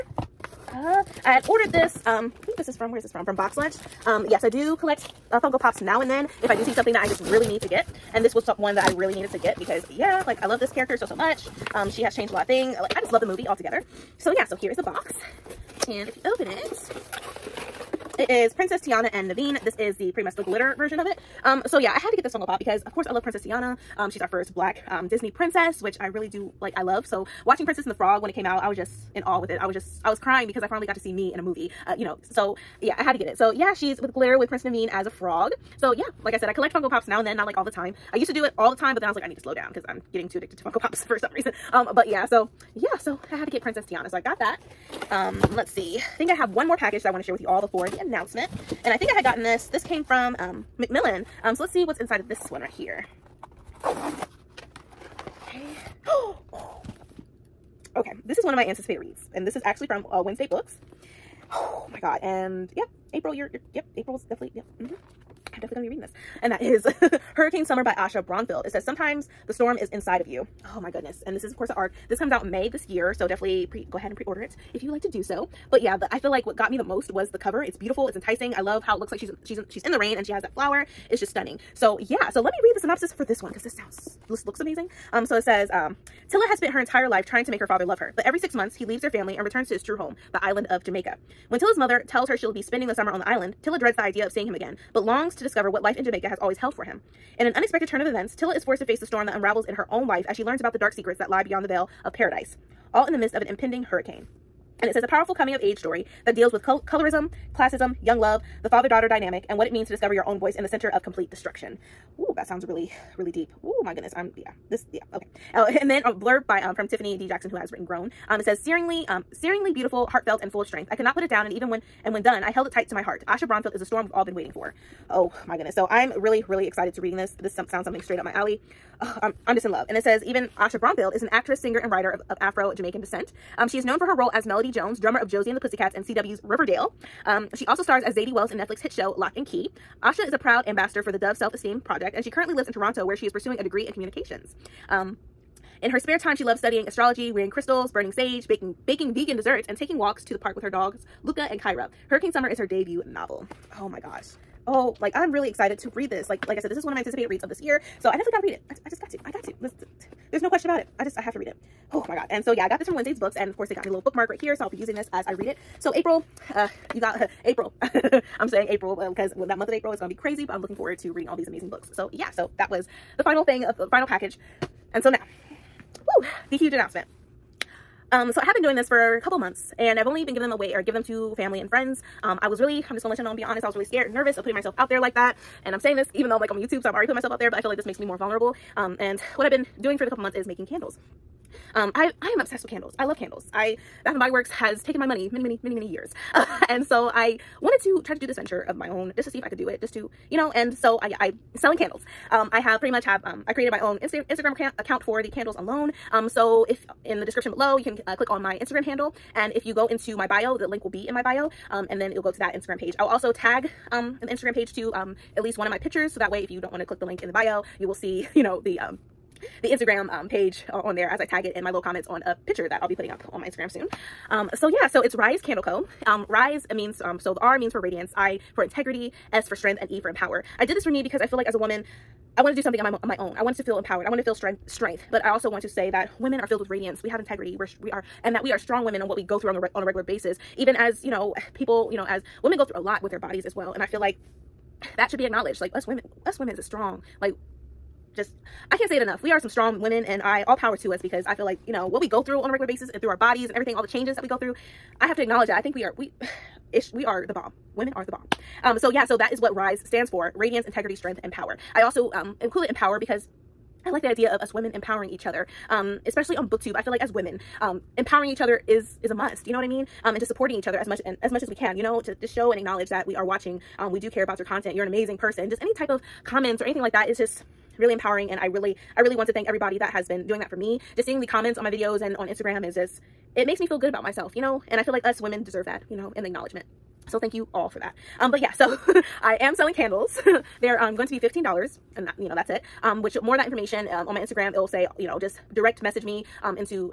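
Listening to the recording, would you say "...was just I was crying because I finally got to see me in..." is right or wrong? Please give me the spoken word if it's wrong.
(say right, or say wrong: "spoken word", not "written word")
right.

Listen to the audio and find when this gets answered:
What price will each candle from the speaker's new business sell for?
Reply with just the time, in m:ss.
4:51.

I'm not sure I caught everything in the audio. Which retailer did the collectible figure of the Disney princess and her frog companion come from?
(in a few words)
Box Lunch.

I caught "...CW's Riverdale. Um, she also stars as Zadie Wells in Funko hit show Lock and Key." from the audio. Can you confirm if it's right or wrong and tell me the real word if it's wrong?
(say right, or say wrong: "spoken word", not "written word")
wrong: "Netflix", not "Funko".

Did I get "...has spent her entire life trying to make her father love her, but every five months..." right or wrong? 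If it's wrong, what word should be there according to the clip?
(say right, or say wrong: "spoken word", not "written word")
wrong: "six", not "five".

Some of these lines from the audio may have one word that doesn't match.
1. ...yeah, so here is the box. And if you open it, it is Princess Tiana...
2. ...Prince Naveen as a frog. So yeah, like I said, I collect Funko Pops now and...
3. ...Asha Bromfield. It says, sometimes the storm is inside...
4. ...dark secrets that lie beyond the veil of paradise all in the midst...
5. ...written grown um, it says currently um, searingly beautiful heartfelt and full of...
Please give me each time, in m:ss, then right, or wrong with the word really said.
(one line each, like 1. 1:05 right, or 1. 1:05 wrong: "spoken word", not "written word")
1. 0:14 right
2. 0:34 right
3. 1:07 right
4. 1:40 right
5. 1:57 wrong: "searingly", not "currently".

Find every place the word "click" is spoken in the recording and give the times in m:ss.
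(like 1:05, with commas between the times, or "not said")
3:28, 3:36.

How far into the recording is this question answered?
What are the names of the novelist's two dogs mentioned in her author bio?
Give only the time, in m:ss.
2:31.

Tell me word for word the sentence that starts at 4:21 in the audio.
I also um, in Empower because I like the idea of us women empowering each other, um, especially on booktube.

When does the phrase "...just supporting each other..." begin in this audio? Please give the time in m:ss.
4:30.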